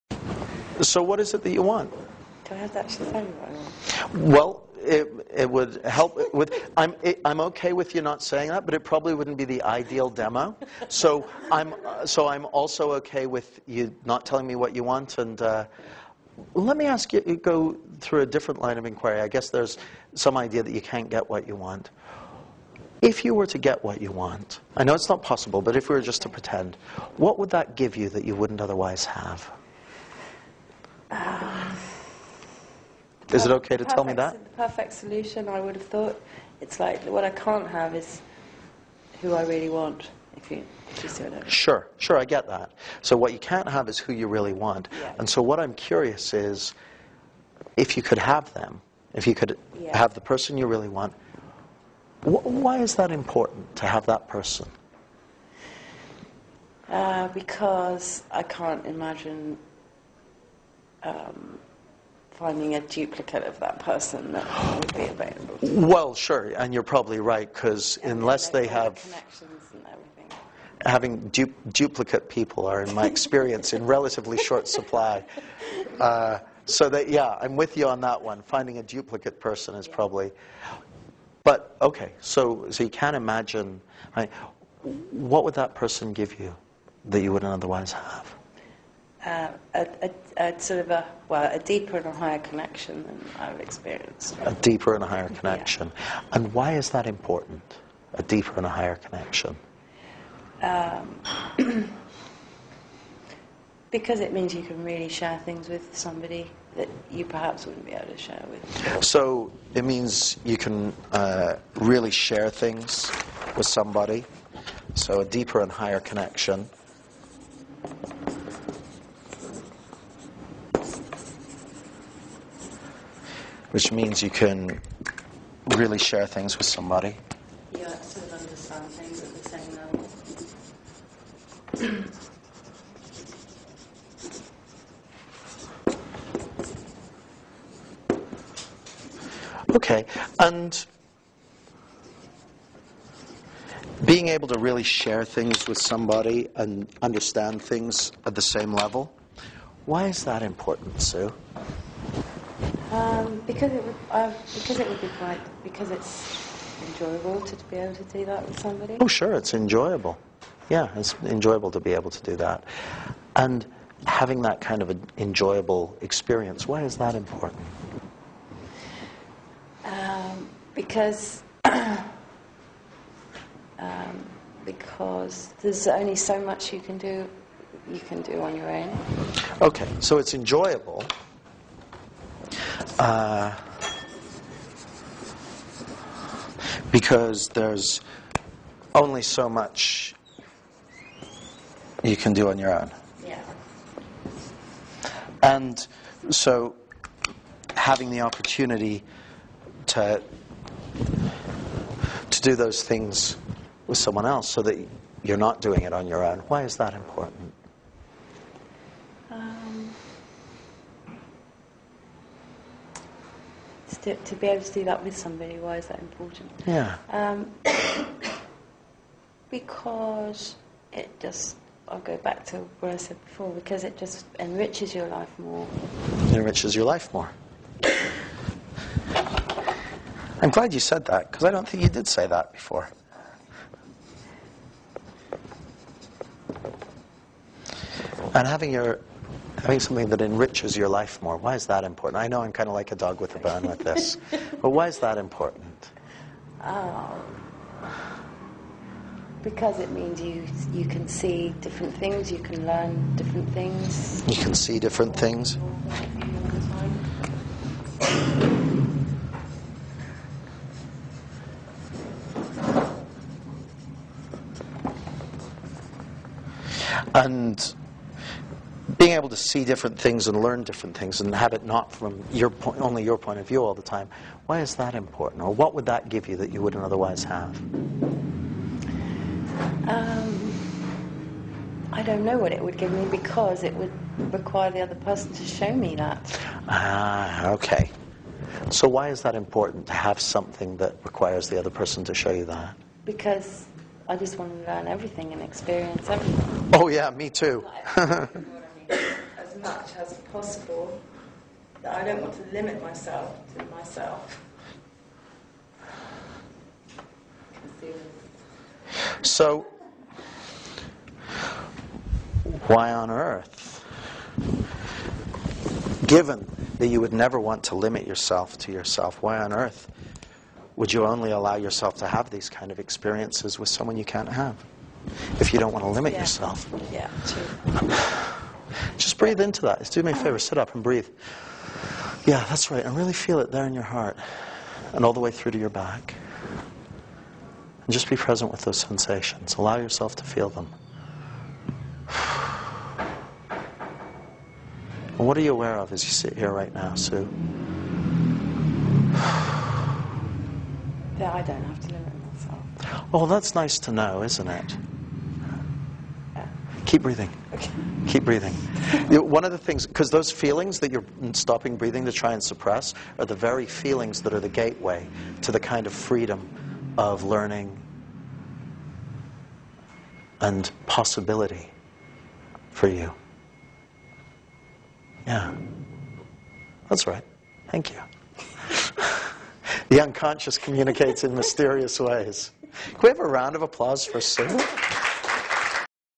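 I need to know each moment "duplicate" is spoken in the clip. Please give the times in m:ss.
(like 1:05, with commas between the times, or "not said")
1:02, 1:11, 1:18.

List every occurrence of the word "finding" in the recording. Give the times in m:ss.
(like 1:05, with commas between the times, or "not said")
1:02, 1:18.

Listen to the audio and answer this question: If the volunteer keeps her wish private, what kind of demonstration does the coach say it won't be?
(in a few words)
the ideal demo.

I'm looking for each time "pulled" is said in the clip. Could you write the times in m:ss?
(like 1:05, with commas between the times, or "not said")
not said.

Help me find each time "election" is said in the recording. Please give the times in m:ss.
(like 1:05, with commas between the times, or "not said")
not said.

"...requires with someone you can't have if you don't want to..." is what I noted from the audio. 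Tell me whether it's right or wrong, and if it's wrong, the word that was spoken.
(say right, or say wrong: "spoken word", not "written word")
wrong: "experiences", not "requires".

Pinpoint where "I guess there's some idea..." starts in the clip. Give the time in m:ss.
0:19.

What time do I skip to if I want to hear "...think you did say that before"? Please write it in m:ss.
3:51.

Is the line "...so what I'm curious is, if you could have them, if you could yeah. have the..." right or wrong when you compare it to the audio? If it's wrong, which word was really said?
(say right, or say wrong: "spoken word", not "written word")
right.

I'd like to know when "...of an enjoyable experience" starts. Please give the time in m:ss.
2:44.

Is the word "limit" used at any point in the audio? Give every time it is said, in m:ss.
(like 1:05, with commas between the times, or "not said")
5:02, 5:17, 5:25, 5:51.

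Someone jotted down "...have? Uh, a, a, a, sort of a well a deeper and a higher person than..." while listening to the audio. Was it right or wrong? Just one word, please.
wrong.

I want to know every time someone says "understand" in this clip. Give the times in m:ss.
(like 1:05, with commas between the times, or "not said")
2:08, 2:27.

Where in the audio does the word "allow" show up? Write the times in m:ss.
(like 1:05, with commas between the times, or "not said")
5:21, 5:39.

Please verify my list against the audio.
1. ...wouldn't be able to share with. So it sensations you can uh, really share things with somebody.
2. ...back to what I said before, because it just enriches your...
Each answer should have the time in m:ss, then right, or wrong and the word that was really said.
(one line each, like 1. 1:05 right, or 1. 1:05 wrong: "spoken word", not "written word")
1. 1:47 wrong: "means", not "sensations"
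2. 3:42 right.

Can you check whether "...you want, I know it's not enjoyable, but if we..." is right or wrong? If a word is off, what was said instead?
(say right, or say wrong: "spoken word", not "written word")
wrong: "possible", not "enjoyable".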